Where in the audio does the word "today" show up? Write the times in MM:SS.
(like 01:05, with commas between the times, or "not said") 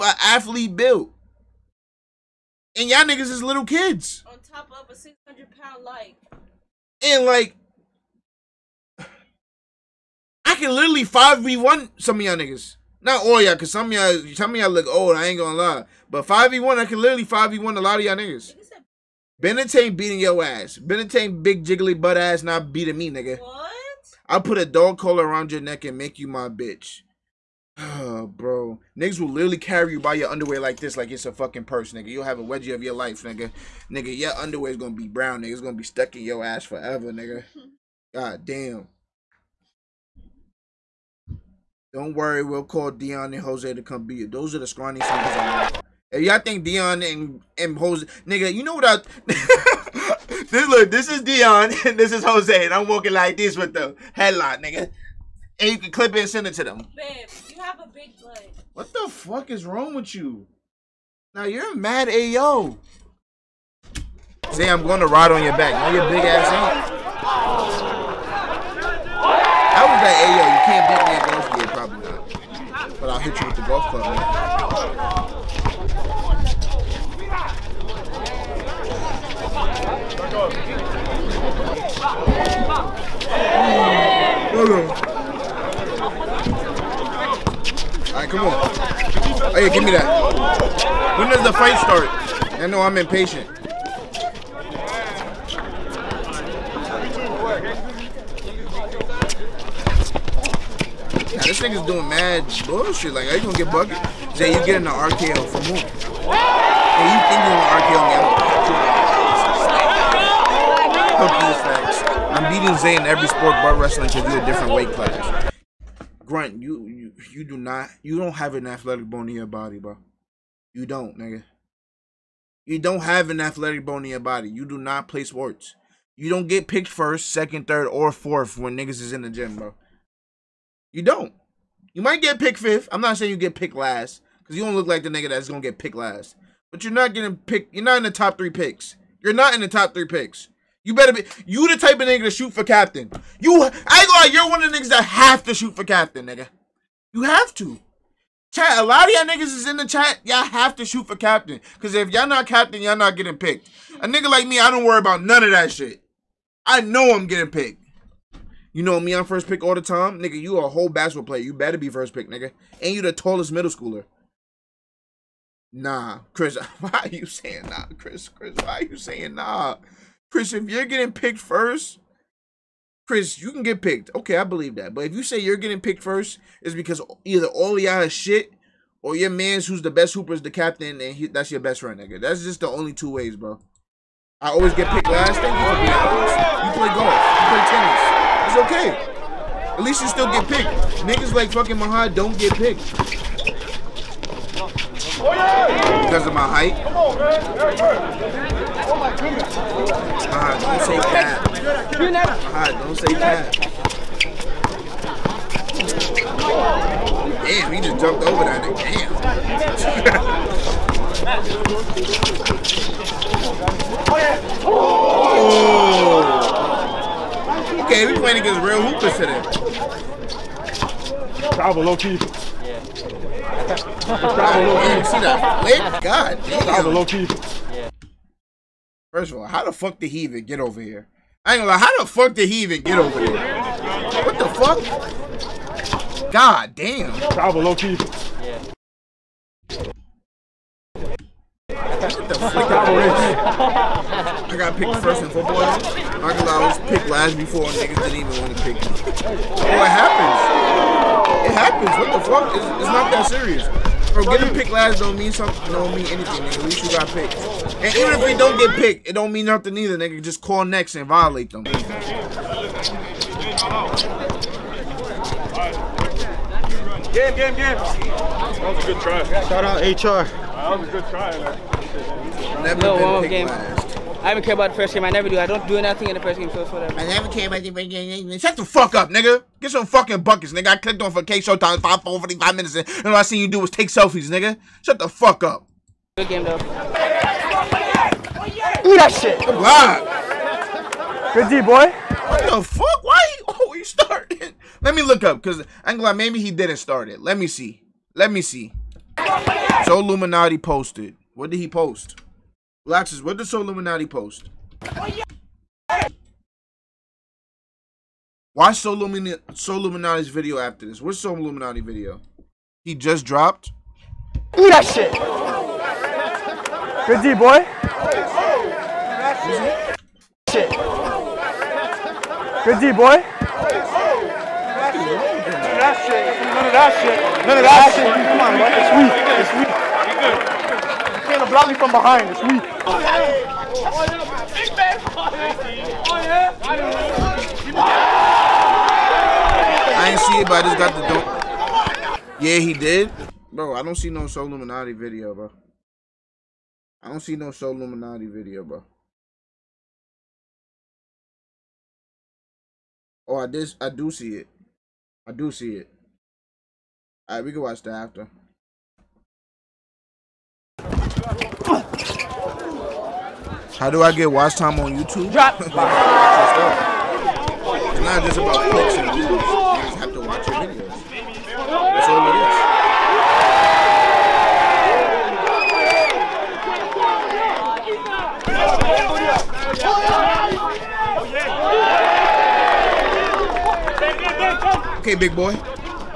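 03:39.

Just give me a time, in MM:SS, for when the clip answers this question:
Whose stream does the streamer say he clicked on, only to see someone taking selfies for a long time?
04:41.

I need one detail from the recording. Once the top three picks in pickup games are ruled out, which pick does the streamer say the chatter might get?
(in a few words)
fifth.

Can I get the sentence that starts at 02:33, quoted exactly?
A nigga like me, I don't worry about none of that shit.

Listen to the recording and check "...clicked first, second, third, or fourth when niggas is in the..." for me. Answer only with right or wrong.
wrong.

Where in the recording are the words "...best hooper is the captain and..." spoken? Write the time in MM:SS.
02:59.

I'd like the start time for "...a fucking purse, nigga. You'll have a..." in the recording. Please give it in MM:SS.
00:31.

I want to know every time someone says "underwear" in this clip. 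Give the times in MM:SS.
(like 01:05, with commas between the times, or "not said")
00:30, 00:34.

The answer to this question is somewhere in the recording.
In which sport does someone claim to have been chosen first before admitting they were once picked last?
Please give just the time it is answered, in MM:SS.
04:05.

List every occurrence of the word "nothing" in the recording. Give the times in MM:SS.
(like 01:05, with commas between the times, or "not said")
04:19, 04:35.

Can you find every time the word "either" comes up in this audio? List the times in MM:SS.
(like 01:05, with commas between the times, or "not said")
02:57, 04:19.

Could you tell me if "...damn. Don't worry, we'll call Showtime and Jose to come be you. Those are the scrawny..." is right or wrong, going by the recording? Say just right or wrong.
wrong.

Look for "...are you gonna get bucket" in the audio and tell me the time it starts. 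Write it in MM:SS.
01:43.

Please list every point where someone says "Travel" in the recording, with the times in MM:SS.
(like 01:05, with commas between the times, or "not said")
03:41, 03:57.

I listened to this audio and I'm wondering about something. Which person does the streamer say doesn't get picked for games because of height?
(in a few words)
Mahad.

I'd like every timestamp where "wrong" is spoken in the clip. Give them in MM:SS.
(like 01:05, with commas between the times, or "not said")
00:59.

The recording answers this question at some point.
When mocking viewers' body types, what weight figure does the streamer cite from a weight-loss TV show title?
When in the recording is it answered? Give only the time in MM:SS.
00:04.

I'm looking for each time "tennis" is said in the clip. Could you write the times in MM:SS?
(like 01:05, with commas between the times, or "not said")
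03:08.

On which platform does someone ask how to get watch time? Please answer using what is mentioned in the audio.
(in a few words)
YouTube.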